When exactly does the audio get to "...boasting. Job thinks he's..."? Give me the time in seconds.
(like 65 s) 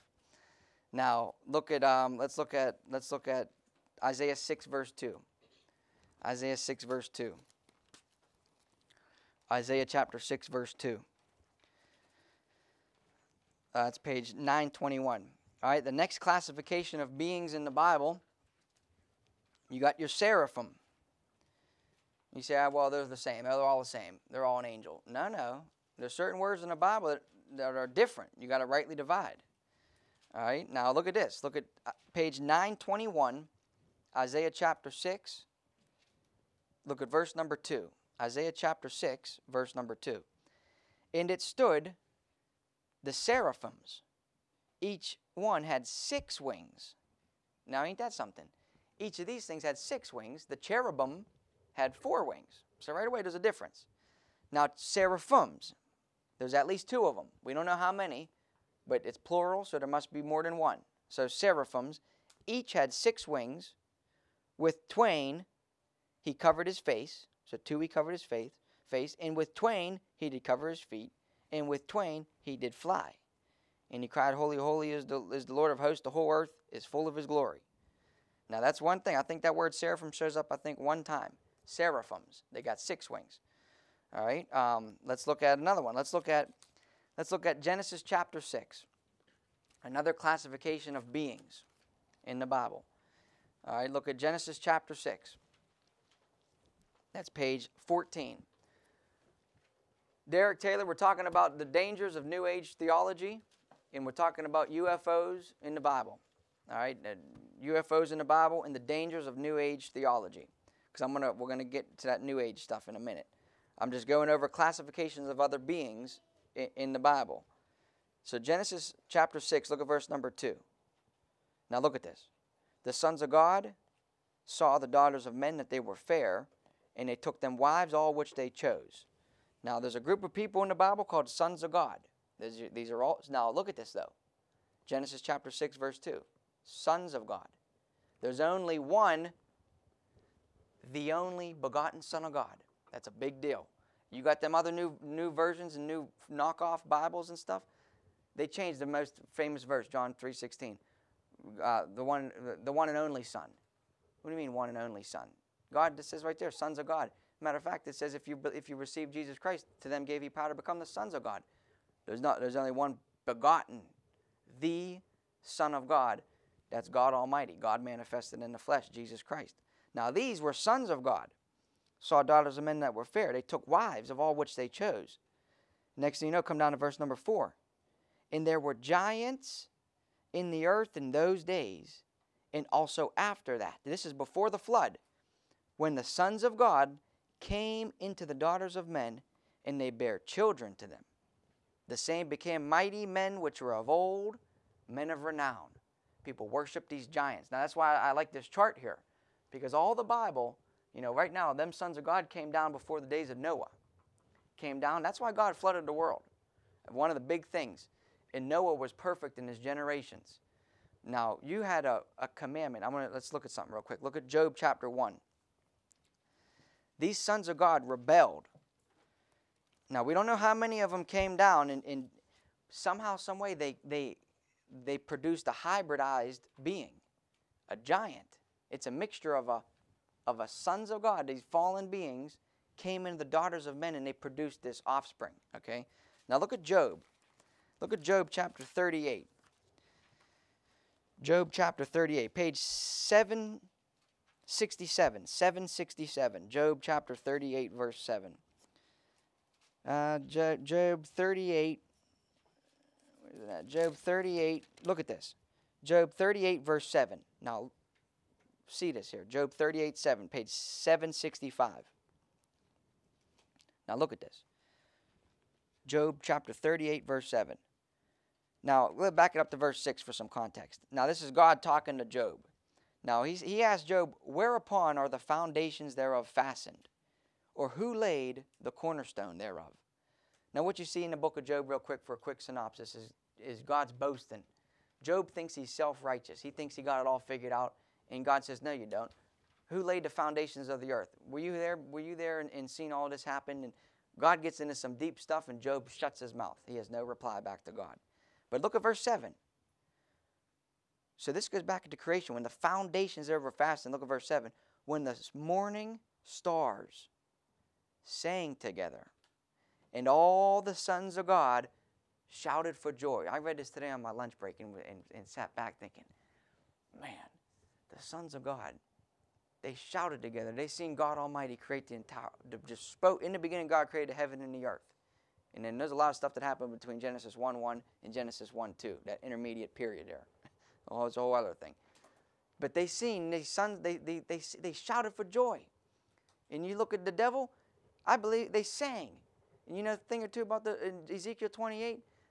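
283 s.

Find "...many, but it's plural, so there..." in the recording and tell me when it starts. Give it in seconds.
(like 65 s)
57 s.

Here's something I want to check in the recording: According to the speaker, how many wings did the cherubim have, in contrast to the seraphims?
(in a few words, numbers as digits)
4.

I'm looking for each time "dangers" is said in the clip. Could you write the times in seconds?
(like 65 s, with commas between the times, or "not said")
101 s, 108 s.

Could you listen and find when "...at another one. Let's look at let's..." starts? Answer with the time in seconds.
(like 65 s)
85 s.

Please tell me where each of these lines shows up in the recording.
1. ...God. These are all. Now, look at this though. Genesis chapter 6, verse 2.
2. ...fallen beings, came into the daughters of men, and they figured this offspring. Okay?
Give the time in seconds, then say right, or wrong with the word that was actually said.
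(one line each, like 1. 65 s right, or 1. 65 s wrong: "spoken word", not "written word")
1. 131 s right
2. 231 s wrong: "produced", not "figured".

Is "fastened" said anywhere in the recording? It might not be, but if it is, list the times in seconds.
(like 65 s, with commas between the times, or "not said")
276 s, 303 s.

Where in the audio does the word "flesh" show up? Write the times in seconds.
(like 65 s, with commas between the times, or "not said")
168 s.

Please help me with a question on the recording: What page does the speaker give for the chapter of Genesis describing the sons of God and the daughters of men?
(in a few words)
14.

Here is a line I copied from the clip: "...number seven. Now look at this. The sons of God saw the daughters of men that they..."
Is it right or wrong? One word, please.
wrong.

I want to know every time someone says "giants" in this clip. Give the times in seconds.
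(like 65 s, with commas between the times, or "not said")
178 s, 197 s, 227 s.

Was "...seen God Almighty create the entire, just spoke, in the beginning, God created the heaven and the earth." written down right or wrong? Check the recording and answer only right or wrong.
right.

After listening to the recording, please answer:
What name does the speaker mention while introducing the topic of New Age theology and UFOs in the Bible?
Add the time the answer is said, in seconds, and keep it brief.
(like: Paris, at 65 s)
Derek Taylor, at 100 s.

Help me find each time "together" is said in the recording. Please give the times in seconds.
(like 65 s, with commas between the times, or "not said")
308 s, 320 s.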